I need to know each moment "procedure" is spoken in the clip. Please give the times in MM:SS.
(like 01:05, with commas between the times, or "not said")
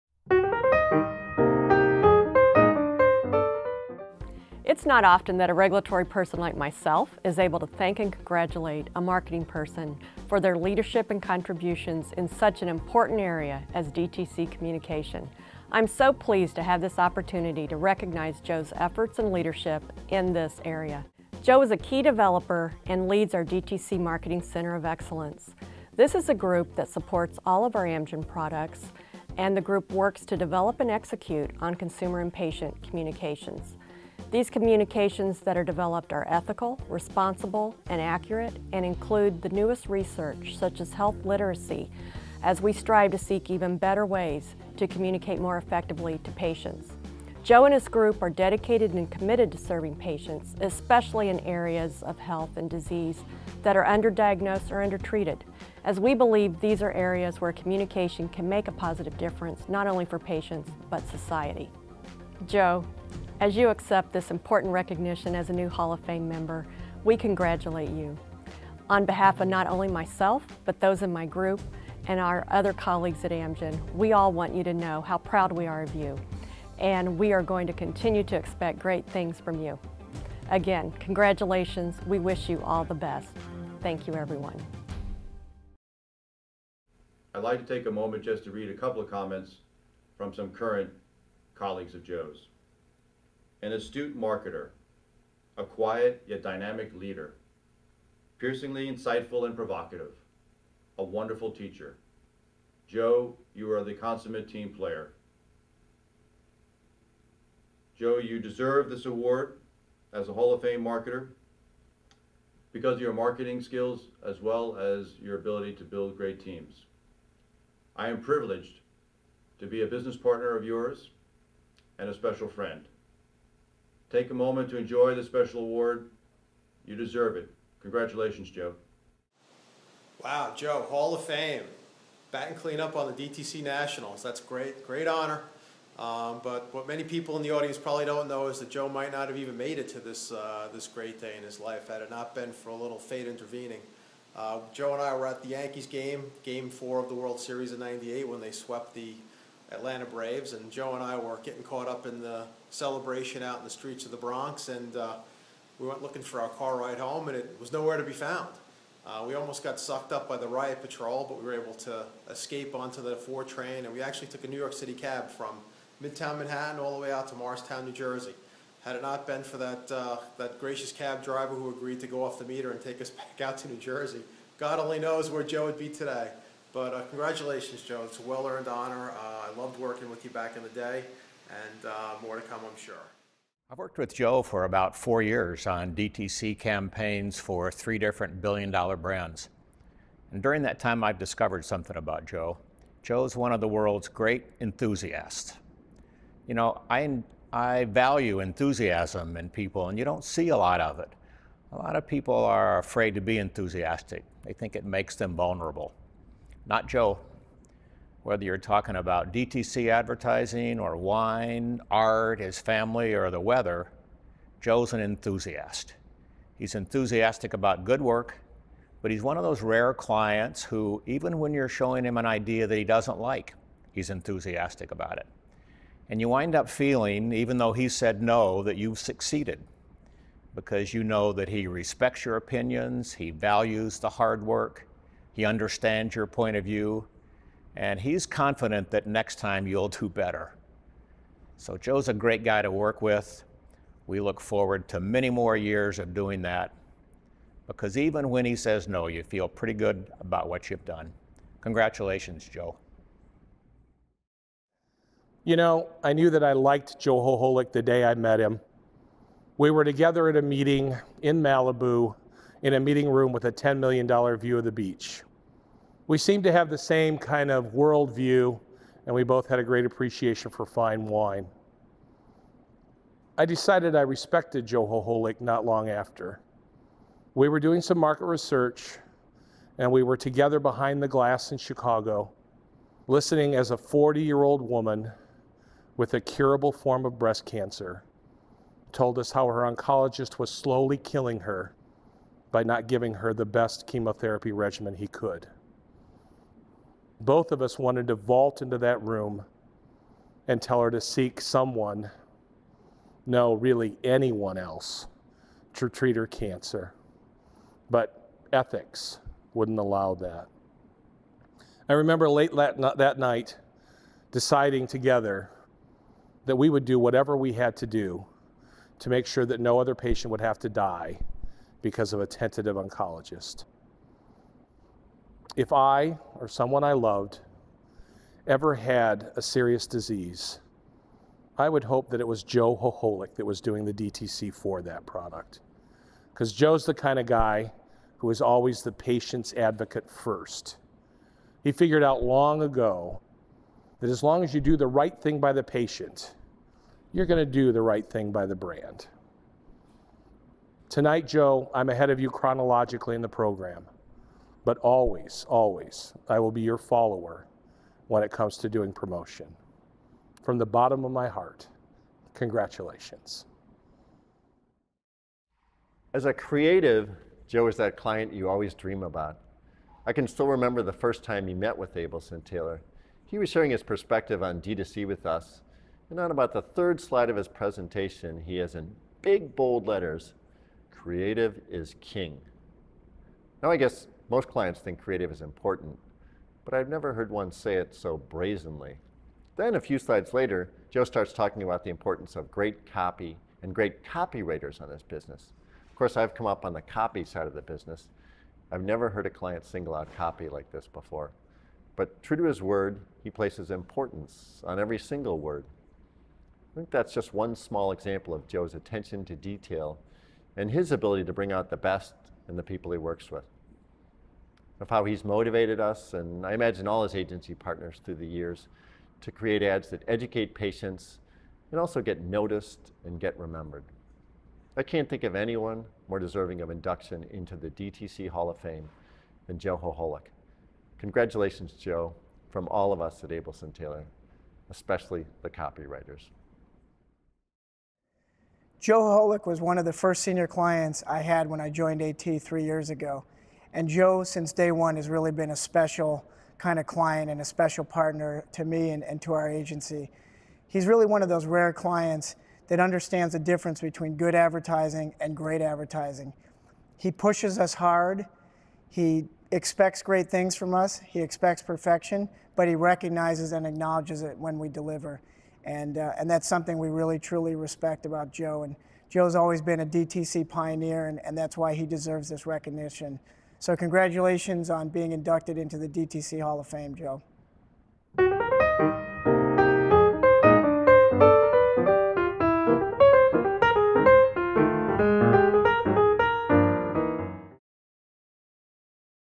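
not said.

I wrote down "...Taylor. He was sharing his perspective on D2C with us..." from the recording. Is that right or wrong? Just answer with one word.
right.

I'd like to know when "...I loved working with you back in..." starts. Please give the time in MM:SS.
02:59.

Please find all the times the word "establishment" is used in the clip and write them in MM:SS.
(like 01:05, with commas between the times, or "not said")
not said.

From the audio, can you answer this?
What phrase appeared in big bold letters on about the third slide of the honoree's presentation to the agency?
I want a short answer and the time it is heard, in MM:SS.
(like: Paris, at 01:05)
creative is king, at 06:20.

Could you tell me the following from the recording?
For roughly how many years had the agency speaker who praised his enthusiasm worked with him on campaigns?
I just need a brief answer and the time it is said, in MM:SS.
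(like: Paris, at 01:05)
4 years, at 03:04.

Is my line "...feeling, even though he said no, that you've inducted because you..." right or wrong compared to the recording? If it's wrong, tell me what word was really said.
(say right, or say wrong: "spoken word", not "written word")
wrong: "succeeded", not "inducted".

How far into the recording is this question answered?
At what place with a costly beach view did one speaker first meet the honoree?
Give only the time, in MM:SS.
04:21.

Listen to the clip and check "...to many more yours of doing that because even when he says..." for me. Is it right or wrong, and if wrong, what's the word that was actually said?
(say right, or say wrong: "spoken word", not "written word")
wrong: "years", not "yours".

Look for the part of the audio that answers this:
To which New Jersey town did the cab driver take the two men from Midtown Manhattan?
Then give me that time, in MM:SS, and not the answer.
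02:47.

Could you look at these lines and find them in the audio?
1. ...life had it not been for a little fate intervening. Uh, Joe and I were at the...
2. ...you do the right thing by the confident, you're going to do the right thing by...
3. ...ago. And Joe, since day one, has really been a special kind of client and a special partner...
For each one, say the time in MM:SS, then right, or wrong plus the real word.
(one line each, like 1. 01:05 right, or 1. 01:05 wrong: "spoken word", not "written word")
1. 02:21 right
2. 05:44 wrong: "patient", not "confident"
3. 07:22 right.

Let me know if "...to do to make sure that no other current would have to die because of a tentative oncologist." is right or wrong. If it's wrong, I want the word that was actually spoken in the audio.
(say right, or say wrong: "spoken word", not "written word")
wrong: "patient", not "current".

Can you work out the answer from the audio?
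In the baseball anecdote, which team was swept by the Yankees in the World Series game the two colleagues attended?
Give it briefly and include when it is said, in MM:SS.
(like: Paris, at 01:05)
Atlanta Braves, at 02:29.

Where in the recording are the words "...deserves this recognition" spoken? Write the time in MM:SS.
07:51.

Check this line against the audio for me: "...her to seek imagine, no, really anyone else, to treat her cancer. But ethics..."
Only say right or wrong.
wrong.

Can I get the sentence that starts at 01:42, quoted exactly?
Joe, you are the consummate team player.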